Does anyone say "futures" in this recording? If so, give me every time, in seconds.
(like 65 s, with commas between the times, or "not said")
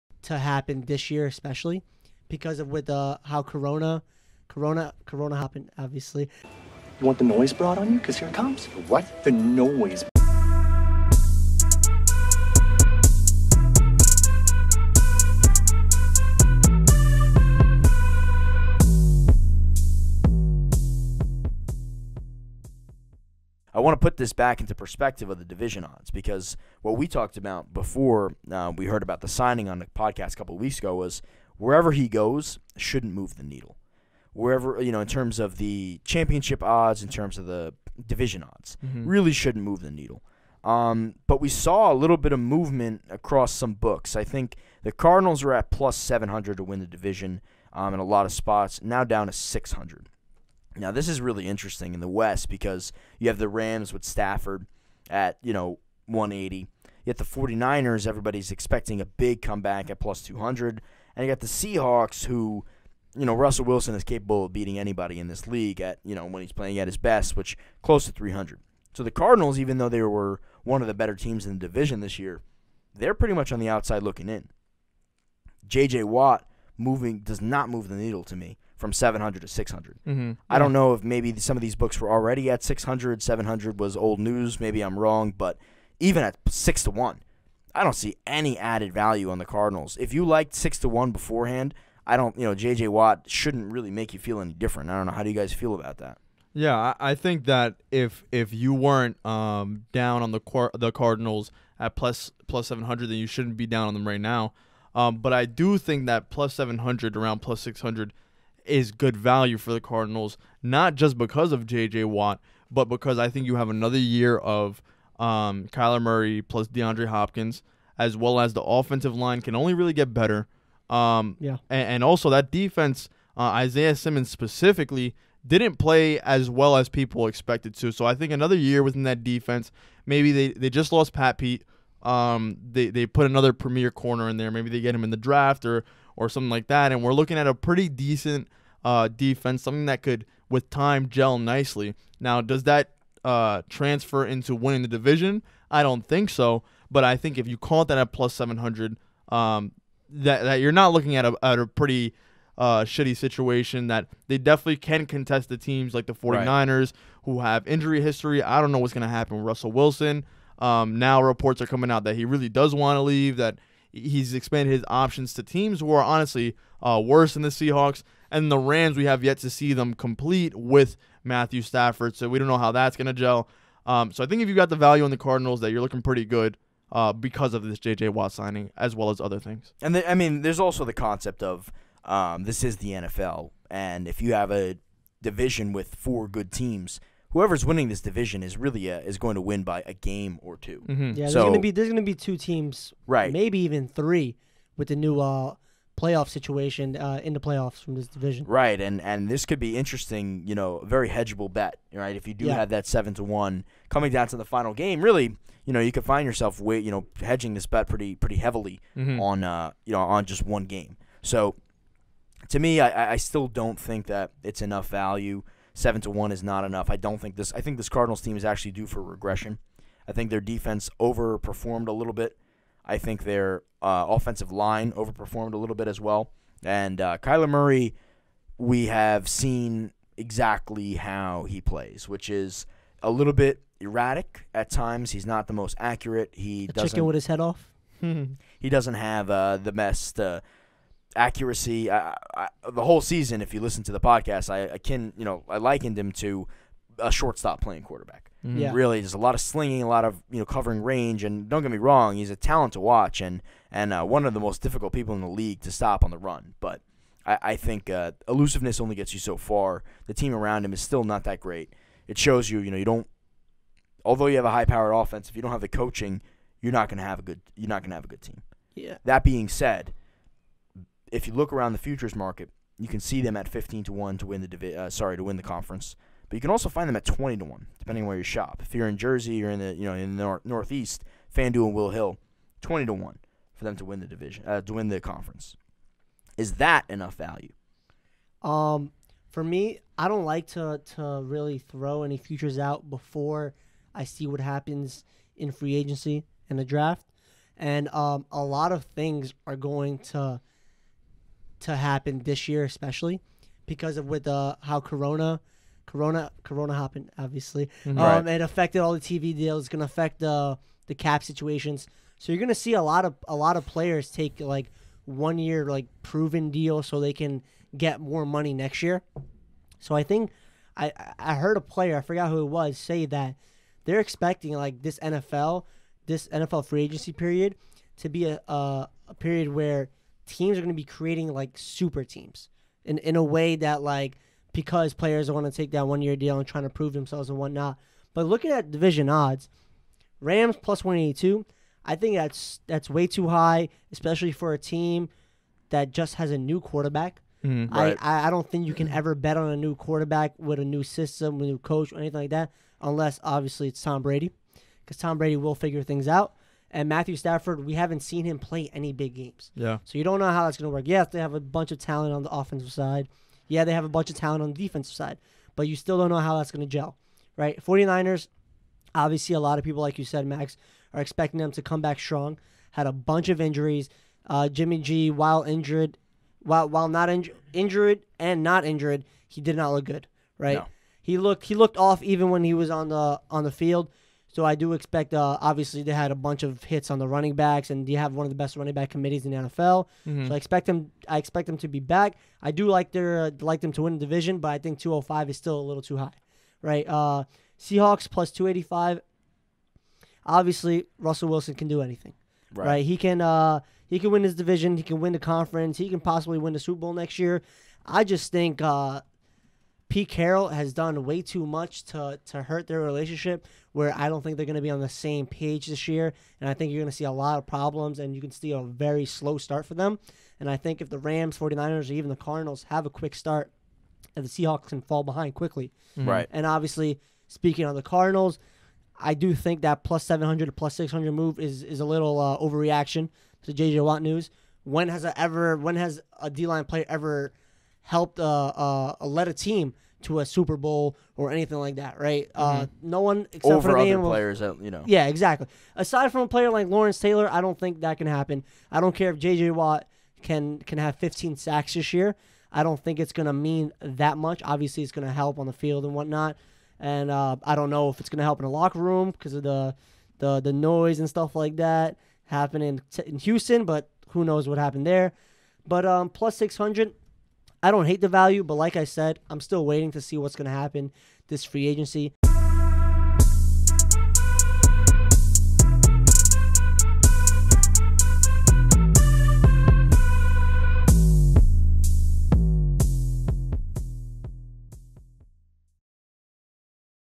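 271 s, 292 s.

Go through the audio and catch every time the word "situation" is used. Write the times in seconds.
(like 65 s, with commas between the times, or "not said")
153 s, 196 s, 311 s.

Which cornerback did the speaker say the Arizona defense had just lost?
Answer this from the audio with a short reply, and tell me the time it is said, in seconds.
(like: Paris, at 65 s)
Pat Pete, at 131 s.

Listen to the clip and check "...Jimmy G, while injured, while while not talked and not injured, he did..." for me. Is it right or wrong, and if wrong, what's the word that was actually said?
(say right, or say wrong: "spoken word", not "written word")
wrong: "injured", not "talked".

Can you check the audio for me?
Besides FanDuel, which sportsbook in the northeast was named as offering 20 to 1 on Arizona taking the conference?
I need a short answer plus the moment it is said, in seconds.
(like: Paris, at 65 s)
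Will Hill, at 281 s.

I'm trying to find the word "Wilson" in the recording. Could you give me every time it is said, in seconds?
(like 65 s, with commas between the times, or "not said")
63 s, 159 s, 401 s.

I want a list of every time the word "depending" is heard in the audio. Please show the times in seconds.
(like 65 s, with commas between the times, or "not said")
277 s.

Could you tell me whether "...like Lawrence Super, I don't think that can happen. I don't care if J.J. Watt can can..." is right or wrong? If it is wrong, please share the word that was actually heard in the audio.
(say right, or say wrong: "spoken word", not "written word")
wrong: "Taylor", not "Super".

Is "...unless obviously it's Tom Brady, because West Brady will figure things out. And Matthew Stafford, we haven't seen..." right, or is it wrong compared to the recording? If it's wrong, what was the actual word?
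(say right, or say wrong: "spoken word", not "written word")
wrong: "Tom", not "West".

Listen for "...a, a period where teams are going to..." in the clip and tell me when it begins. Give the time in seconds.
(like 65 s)
328 s.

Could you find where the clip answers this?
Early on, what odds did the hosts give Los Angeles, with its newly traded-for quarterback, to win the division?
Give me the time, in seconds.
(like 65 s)
56 s.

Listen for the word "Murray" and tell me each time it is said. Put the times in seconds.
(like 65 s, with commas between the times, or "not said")
116 s, 227 s.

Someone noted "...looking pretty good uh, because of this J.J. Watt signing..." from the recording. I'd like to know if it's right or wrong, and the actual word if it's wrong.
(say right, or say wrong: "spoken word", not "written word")
right.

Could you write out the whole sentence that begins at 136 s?
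And we're looking at a pretty decent uh, defense, something that could, with time, gel nicely.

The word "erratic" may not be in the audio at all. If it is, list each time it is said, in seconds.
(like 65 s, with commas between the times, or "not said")
233 s.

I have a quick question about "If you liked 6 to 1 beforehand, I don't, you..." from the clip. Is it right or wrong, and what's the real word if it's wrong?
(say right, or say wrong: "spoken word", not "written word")
right.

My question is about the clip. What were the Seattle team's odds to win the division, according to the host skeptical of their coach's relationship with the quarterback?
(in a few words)
+285.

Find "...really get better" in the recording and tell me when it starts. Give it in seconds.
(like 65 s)
119 s.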